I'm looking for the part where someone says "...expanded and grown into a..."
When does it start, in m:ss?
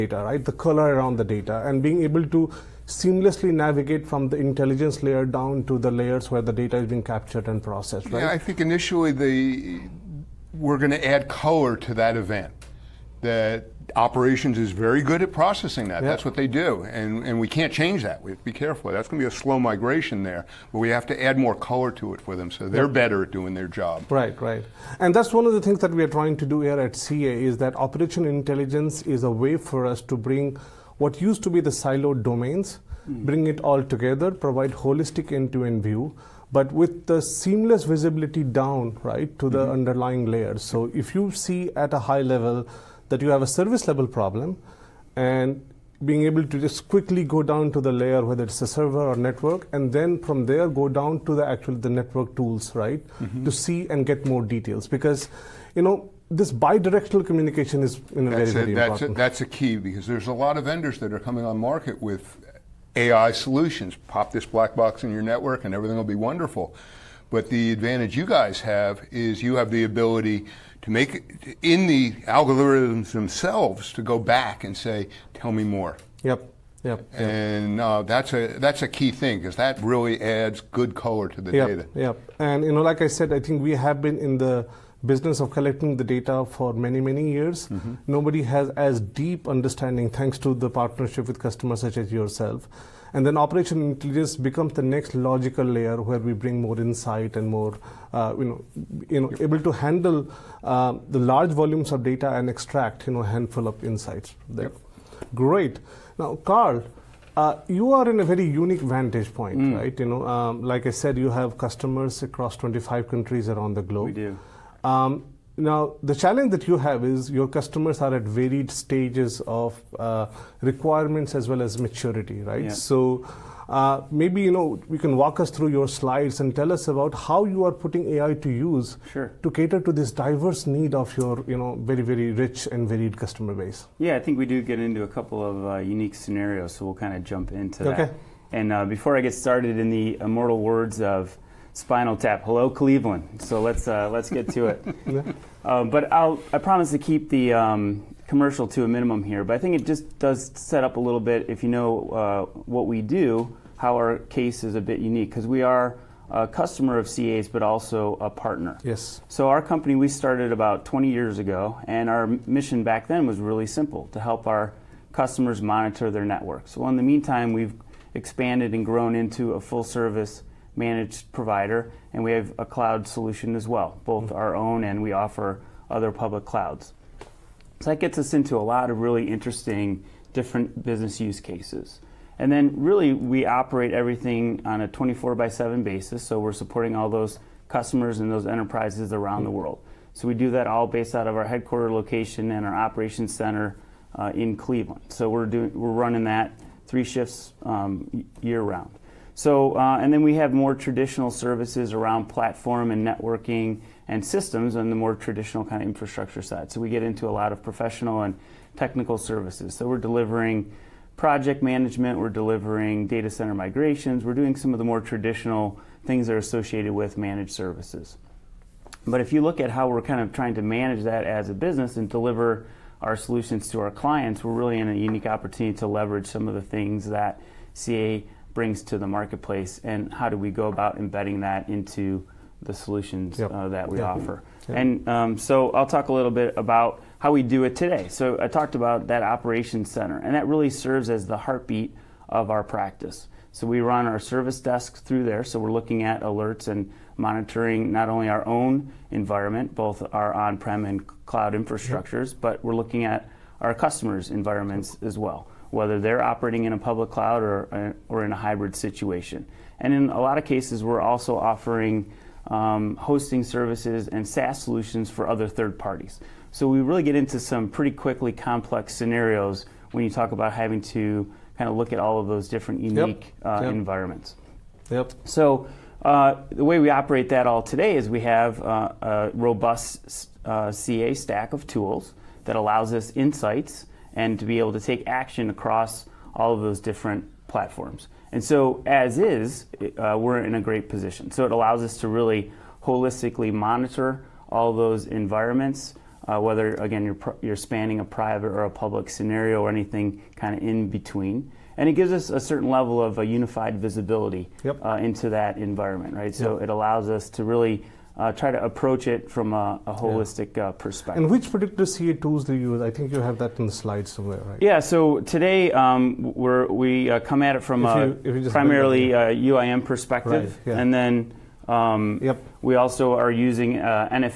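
2:48.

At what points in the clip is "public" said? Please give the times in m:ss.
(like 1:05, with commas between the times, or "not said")
2:56, 4:16, 4:58.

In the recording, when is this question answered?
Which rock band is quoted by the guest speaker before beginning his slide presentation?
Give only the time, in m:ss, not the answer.
2:21.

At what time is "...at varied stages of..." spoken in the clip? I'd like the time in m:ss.
1:58.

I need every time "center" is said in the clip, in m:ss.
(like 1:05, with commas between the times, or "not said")
3:13, 3:33, 3:59.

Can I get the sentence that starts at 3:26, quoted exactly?
So we get into a lot of professional and technical services.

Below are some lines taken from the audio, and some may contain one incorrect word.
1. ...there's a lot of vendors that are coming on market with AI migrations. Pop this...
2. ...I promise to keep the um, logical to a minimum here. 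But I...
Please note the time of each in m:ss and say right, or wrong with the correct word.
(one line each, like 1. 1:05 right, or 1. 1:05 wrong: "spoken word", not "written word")
1. 1:00 wrong: "solutions", not "migrations"
2. 2:26 wrong: "commercial", not "logical".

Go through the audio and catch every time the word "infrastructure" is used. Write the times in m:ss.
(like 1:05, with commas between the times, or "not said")
3:25, 4:11.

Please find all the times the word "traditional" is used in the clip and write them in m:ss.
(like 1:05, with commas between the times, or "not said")
3:20, 3:25, 3:35.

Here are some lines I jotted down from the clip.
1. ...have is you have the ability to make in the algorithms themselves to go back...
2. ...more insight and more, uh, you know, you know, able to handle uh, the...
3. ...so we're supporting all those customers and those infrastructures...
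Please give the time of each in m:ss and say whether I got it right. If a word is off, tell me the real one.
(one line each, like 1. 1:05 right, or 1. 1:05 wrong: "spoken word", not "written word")
1. 1:08 right
2. 1:36 right
3. 3:06 wrong: "enterprises", not "infrastructures".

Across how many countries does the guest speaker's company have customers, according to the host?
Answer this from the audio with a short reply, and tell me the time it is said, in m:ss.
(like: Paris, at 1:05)
25, at 1:52.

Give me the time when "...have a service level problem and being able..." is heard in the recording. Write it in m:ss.
0:43.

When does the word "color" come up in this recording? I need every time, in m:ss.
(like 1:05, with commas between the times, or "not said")
0:00, 0:11, 0:21, 1:20.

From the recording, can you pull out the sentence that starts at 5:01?
And it gives us a certain level of a unified visibility yep.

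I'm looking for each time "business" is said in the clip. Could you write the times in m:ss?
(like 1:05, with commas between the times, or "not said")
1:25, 3:00, 3:41.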